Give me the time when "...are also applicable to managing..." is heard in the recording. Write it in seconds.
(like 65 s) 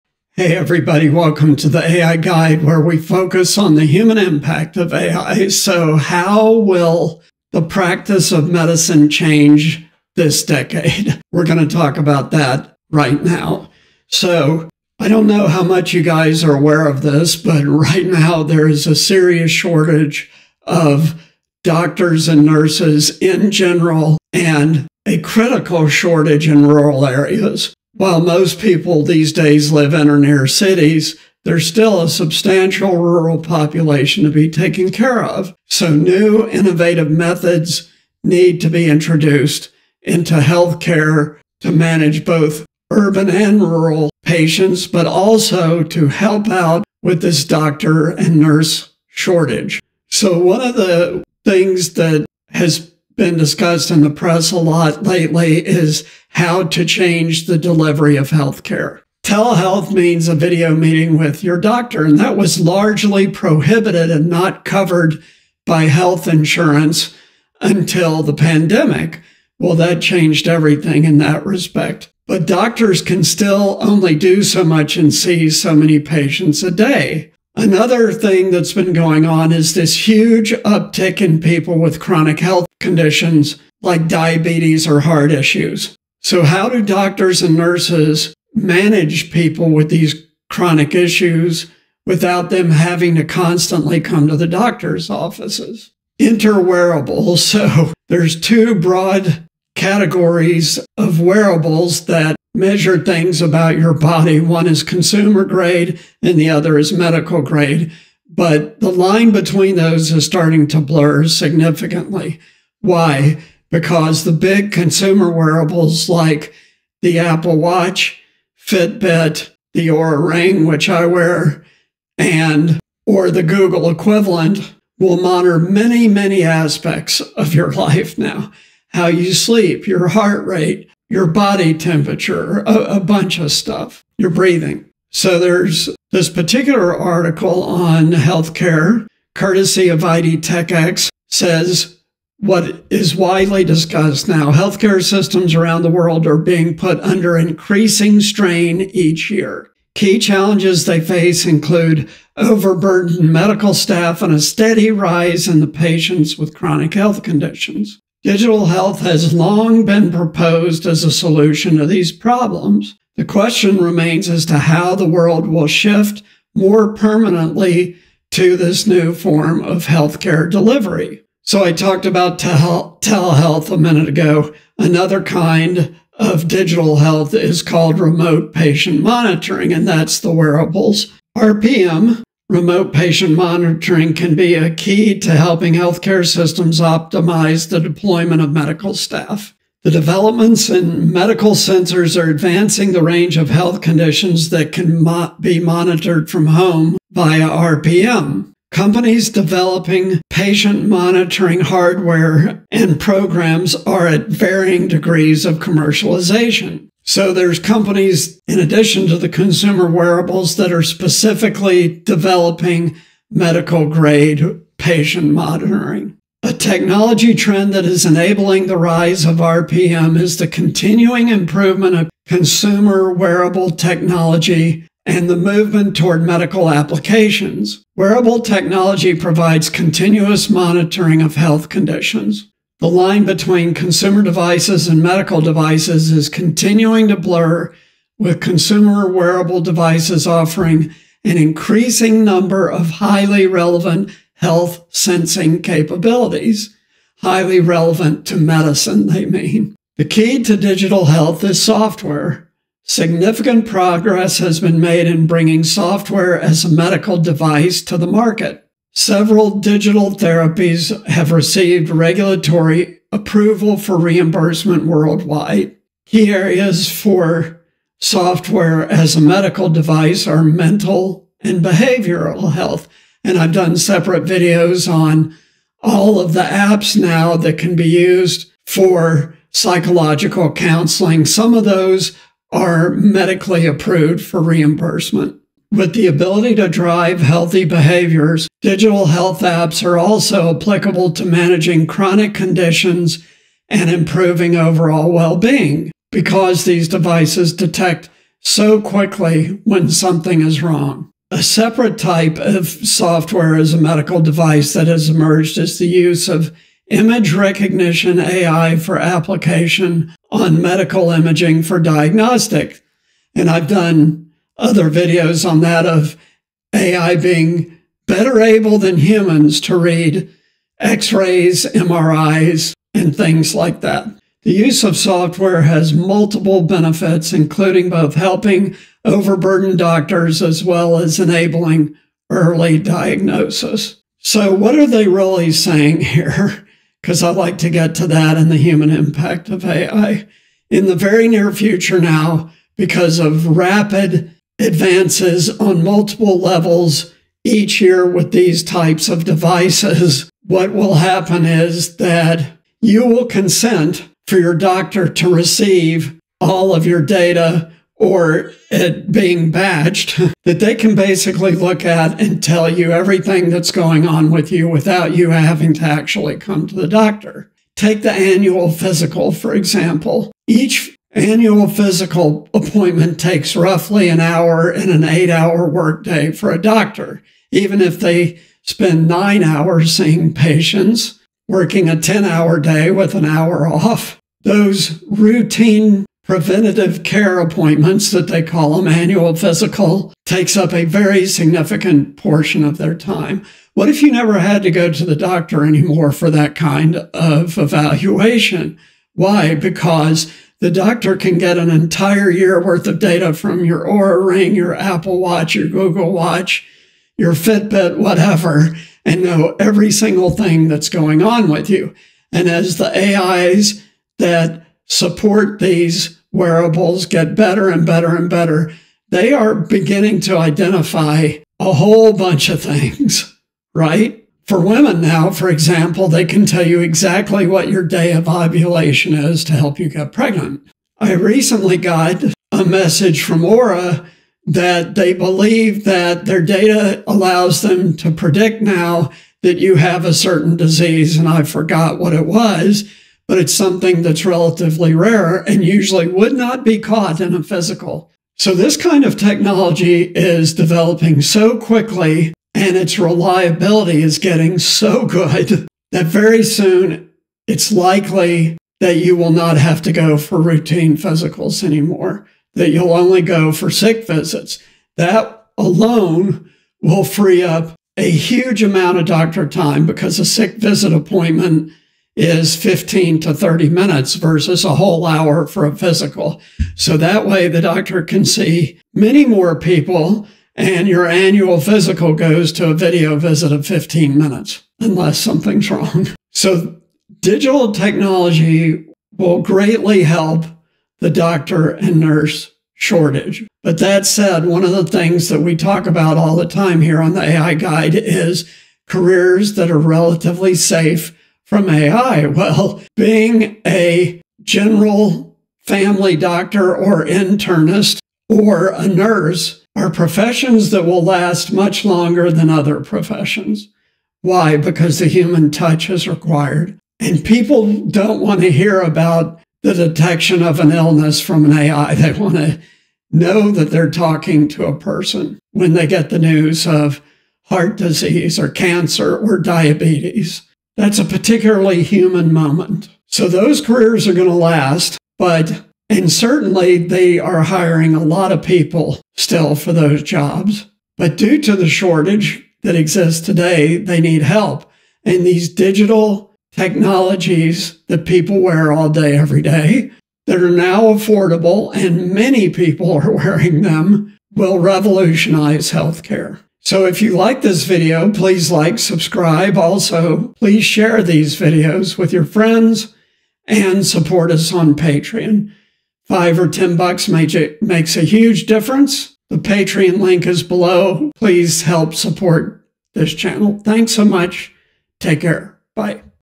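289 s.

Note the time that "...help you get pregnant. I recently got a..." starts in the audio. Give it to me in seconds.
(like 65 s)
429 s.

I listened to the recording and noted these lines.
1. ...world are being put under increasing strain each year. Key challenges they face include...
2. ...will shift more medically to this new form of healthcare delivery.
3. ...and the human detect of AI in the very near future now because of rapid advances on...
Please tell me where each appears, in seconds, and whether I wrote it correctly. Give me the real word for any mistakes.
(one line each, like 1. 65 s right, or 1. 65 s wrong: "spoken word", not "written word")
1. 145 s right
2. 165 s wrong: "permanently", not "medically"
3. 338 s wrong: "impact", not "detect".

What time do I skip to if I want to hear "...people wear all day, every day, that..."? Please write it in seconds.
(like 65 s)
548 s.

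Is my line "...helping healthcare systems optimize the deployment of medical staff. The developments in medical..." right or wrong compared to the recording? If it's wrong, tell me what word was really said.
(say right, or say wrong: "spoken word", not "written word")
right.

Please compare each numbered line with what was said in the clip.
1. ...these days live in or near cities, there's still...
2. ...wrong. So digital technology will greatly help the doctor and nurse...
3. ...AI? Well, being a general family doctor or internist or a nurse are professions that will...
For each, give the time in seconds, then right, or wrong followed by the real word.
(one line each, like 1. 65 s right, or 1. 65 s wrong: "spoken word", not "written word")
1. 29 s right
2. 485 s right
3. 501 s right.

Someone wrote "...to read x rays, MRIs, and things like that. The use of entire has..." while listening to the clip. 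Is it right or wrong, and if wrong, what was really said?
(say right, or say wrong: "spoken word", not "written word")
wrong: "software", not "entire".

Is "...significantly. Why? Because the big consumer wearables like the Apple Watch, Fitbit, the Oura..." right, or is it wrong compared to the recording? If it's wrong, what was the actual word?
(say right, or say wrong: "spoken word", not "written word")
right.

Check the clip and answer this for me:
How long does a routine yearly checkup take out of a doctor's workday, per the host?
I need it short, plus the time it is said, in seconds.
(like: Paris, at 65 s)
roughly an hour, at 373 s.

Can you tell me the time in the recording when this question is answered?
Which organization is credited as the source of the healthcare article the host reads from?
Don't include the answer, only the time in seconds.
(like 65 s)
140 s.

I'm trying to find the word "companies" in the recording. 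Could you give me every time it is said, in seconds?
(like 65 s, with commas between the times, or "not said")
198 s, 207 s.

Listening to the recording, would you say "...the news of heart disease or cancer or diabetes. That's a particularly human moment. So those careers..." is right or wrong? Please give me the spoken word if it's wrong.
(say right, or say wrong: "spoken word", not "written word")
right.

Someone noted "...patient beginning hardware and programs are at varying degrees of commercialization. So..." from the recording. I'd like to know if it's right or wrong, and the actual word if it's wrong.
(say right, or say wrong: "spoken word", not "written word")
wrong: "monitoring", not "beginning".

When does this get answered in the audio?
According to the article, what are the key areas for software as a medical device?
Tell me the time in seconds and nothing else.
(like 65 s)
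270 s.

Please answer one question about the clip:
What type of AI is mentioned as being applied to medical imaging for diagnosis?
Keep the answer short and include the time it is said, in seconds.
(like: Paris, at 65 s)
image recognition, at 306 s.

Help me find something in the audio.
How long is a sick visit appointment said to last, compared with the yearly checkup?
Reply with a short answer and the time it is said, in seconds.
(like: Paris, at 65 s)
15 to 30 minutes, at 472 s.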